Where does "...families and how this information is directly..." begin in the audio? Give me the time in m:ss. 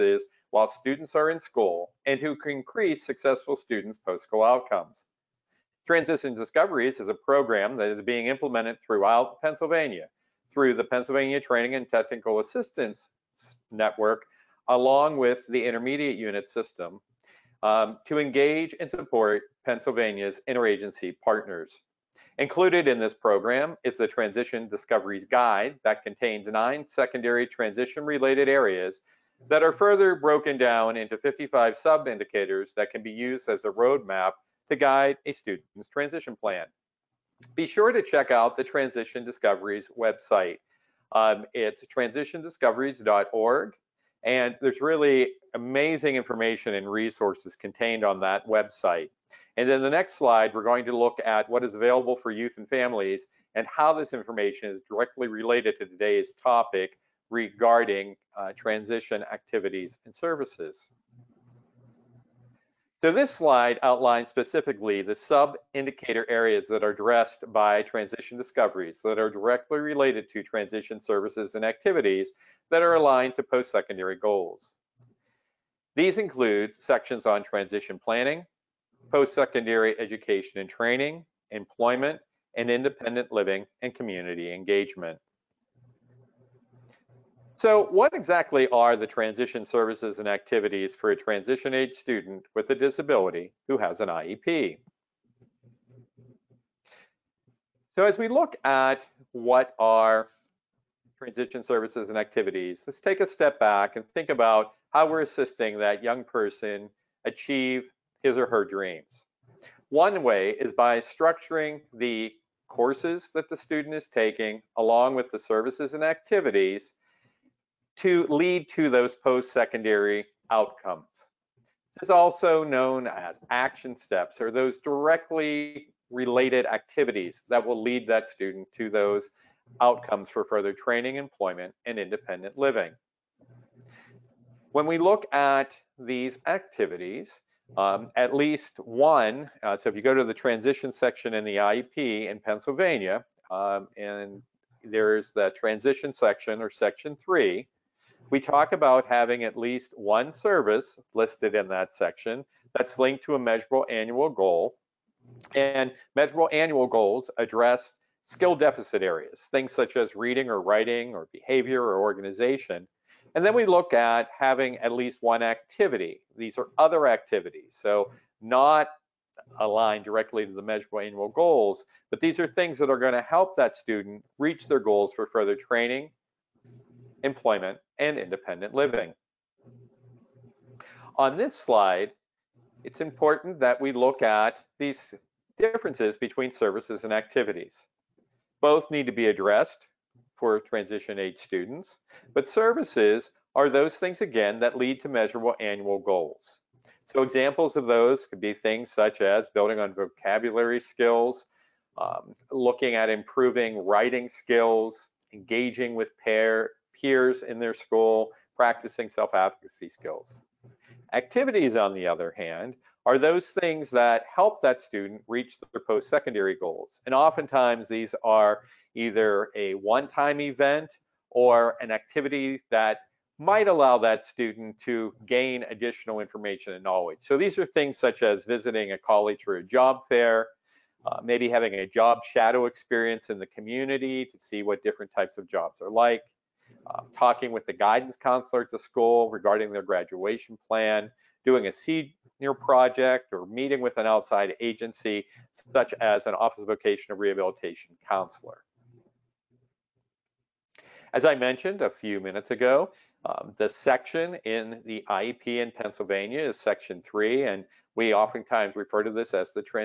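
0:52.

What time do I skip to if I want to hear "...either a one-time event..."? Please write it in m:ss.
3:38.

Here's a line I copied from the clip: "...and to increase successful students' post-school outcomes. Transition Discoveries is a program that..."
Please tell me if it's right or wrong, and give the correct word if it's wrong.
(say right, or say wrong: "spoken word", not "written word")
right.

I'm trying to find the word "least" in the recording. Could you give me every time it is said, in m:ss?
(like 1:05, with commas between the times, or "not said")
2:18, 2:29, 2:44.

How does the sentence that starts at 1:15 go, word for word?
These include sections on transition planning, post-secondary education and training, employment, and independent living and community engagement.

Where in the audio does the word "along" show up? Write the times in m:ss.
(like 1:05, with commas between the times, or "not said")
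0:14, 1:54.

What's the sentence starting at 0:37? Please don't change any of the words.
Be sure to check out the Transition Discoveries website.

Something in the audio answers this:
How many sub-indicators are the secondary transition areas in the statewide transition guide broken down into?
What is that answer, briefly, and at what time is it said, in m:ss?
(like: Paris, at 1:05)
55, at 0:31.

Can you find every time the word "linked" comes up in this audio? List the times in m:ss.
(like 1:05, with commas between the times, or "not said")
2:32.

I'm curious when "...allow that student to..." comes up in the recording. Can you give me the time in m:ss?
3:43.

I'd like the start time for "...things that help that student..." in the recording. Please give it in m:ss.
3:33.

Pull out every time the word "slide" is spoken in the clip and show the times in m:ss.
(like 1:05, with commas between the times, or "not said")
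0:50, 1:03, 3:01.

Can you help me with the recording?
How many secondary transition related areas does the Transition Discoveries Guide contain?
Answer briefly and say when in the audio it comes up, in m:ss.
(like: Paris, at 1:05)
9, at 0:26.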